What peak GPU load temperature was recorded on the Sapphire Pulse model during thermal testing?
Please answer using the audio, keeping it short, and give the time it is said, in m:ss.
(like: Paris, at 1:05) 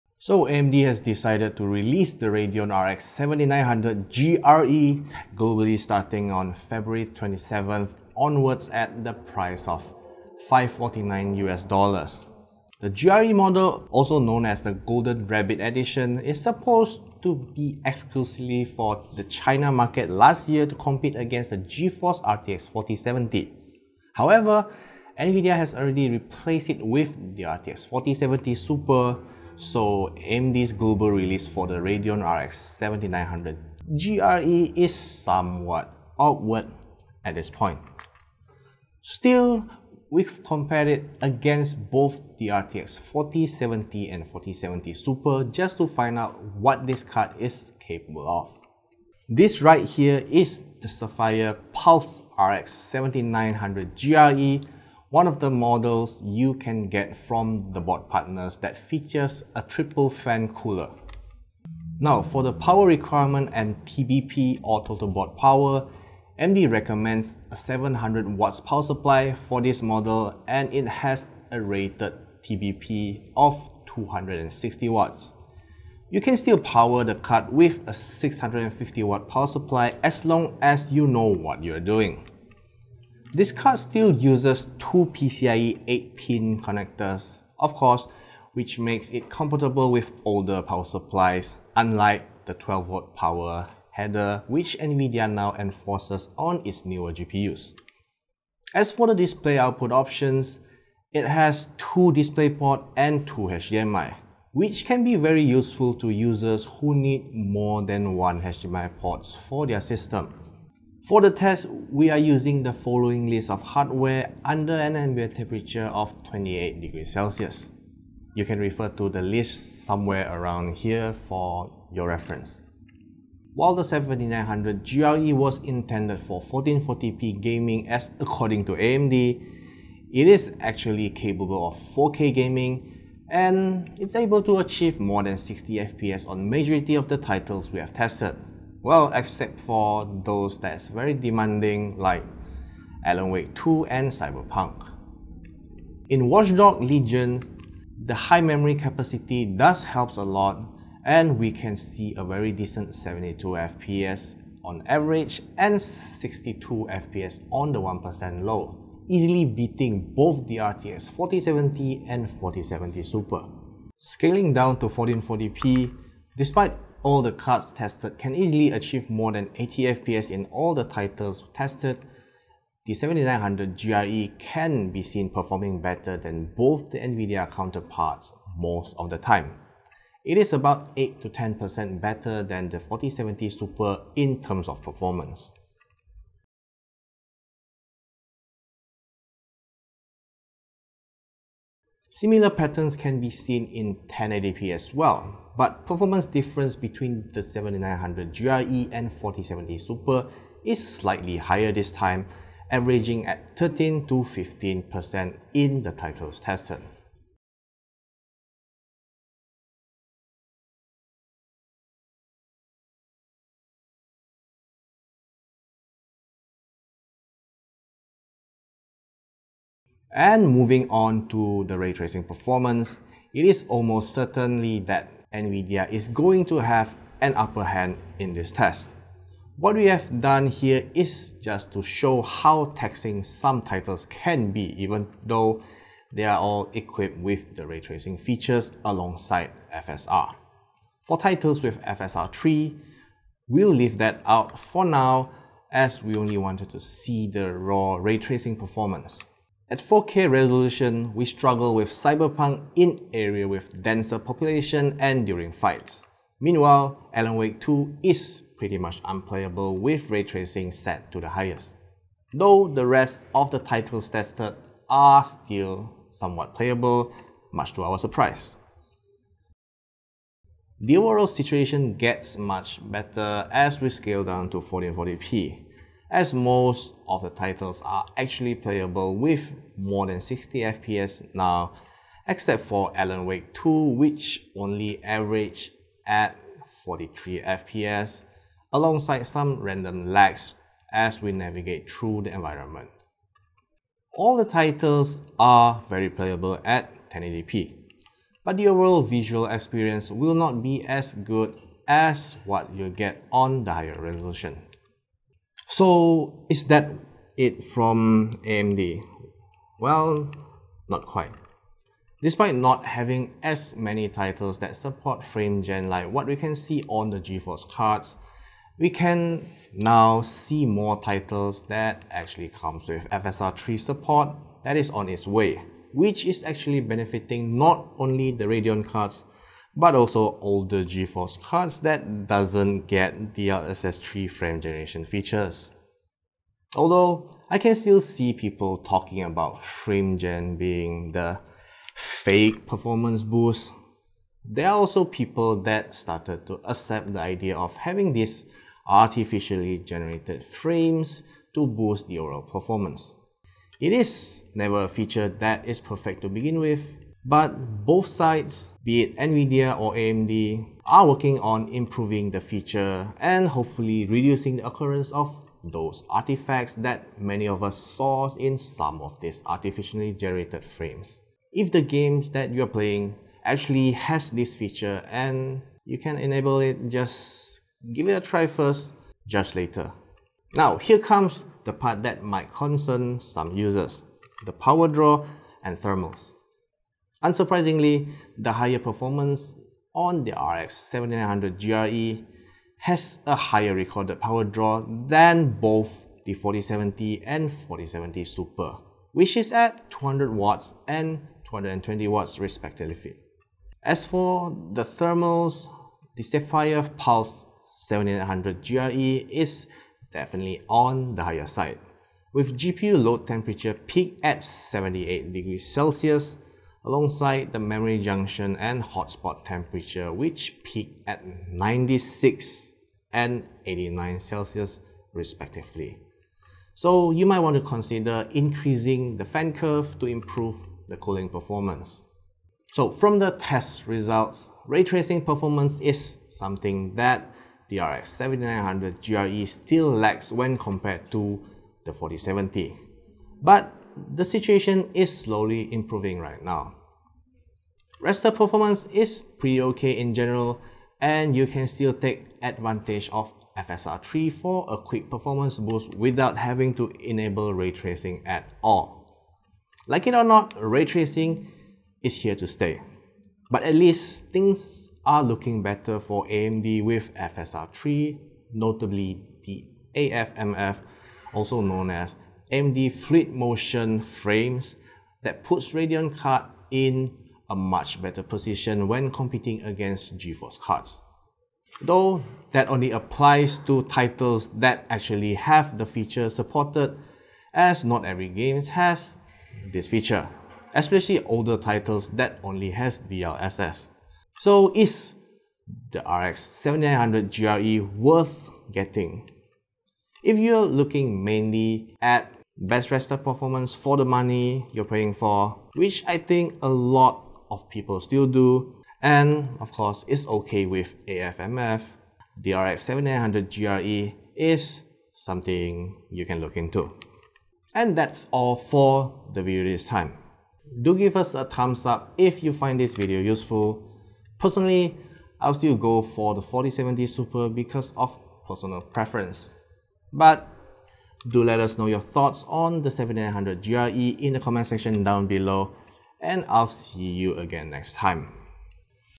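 78 degrees Celsius, at 6:54.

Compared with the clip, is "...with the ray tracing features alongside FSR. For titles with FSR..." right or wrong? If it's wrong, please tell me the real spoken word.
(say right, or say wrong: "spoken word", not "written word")
right.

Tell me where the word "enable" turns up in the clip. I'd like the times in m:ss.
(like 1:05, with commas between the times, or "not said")
6:16, 7:37.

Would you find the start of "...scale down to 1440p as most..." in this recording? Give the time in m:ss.
4:33.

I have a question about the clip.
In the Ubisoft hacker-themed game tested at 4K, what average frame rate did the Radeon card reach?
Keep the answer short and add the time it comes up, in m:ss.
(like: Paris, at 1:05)
72 FPS, at 2:32.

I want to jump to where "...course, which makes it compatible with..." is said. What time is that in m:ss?
1:27.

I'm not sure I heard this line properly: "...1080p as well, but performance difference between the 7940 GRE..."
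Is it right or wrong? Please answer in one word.
wrong.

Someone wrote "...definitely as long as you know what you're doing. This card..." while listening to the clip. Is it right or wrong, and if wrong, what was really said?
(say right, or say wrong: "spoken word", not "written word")
wrong: "supply", not "definitely".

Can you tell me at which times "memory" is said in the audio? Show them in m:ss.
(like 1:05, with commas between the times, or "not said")
2:28, 6:57.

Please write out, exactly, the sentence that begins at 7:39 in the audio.
Like it or not, ray tracing is here to stay.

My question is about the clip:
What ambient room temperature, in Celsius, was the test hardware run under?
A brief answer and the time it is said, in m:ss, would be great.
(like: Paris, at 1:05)
28 degrees Celsius, at 1:56.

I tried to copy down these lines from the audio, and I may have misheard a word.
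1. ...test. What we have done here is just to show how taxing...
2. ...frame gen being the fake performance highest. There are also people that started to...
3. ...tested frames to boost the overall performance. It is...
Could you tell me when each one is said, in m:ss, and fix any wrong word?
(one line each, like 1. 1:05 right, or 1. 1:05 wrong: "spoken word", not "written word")
1. 3:48 right
2. 5:39 wrong: "boost", not "highest"
3. 5:49 wrong: "generated", not "tested".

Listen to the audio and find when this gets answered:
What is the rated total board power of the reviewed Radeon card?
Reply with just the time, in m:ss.
1:13.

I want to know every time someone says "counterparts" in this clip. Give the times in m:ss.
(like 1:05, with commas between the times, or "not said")
2:57.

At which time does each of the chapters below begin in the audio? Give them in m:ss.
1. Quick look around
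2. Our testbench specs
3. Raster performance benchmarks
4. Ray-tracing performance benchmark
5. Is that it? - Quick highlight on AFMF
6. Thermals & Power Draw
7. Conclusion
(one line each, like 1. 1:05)
1. 0:12
2. 1:50
3. 2:03
4. 3:39
5. 5:05
6. 6:20
7. 7:12.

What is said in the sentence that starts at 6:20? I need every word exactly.
Now, here comes the part that might concern some users, the power draw and thermals.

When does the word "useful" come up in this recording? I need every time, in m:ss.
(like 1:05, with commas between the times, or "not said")
1:45, 8:43.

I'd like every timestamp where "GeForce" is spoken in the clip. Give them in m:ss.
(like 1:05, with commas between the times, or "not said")
0:21, 5:17, 5:30, 8:00.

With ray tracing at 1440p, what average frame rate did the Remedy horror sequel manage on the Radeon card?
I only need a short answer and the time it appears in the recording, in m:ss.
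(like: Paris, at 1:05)
43 FPS, at 4:46.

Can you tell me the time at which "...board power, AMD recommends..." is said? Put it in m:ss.
1:05.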